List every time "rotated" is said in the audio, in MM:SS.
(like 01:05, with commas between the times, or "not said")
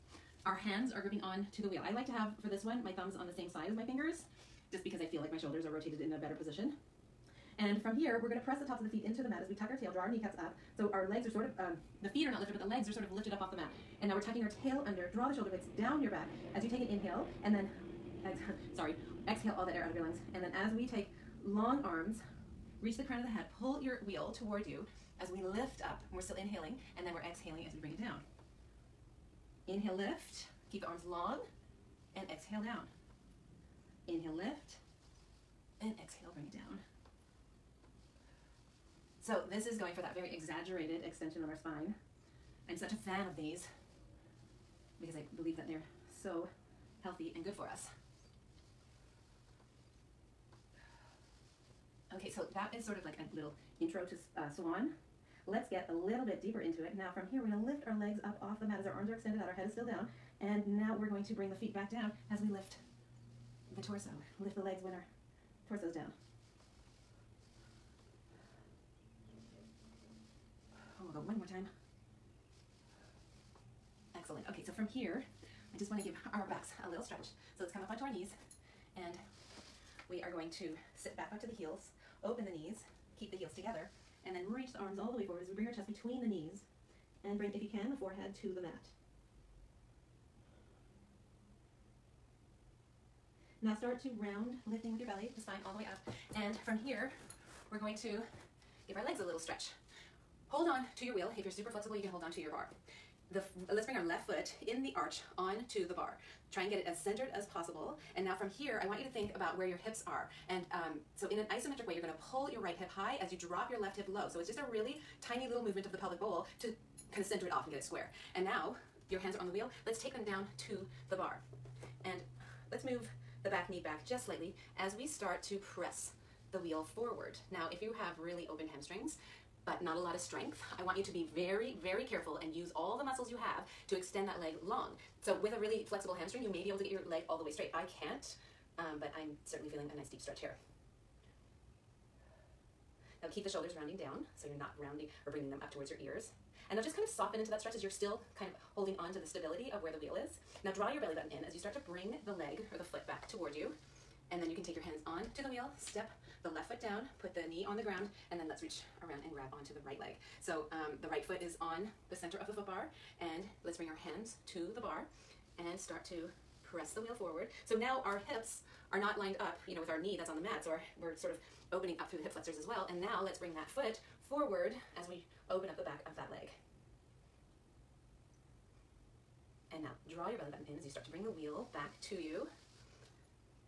00:05.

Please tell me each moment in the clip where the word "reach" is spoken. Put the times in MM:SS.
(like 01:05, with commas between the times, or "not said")
00:22, 01:24, 02:38.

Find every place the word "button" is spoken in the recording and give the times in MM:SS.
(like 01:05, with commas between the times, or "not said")
02:31, 03:00.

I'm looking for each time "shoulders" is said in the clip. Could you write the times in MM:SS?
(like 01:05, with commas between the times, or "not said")
00:05, 00:15, 02:23.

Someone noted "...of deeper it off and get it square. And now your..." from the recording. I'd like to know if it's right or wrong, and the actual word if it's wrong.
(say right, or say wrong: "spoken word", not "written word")
wrong: "center", not "deeper".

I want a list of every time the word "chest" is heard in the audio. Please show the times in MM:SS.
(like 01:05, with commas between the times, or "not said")
01:25.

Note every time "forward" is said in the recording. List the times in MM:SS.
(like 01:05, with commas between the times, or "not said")
01:25, 02:06, 02:47, 02:54.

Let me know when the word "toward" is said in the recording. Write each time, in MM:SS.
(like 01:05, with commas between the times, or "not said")
00:24, 02:25, 02:33.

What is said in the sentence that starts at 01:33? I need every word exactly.
Now start to round, lifting with your belly, the spine all the way up.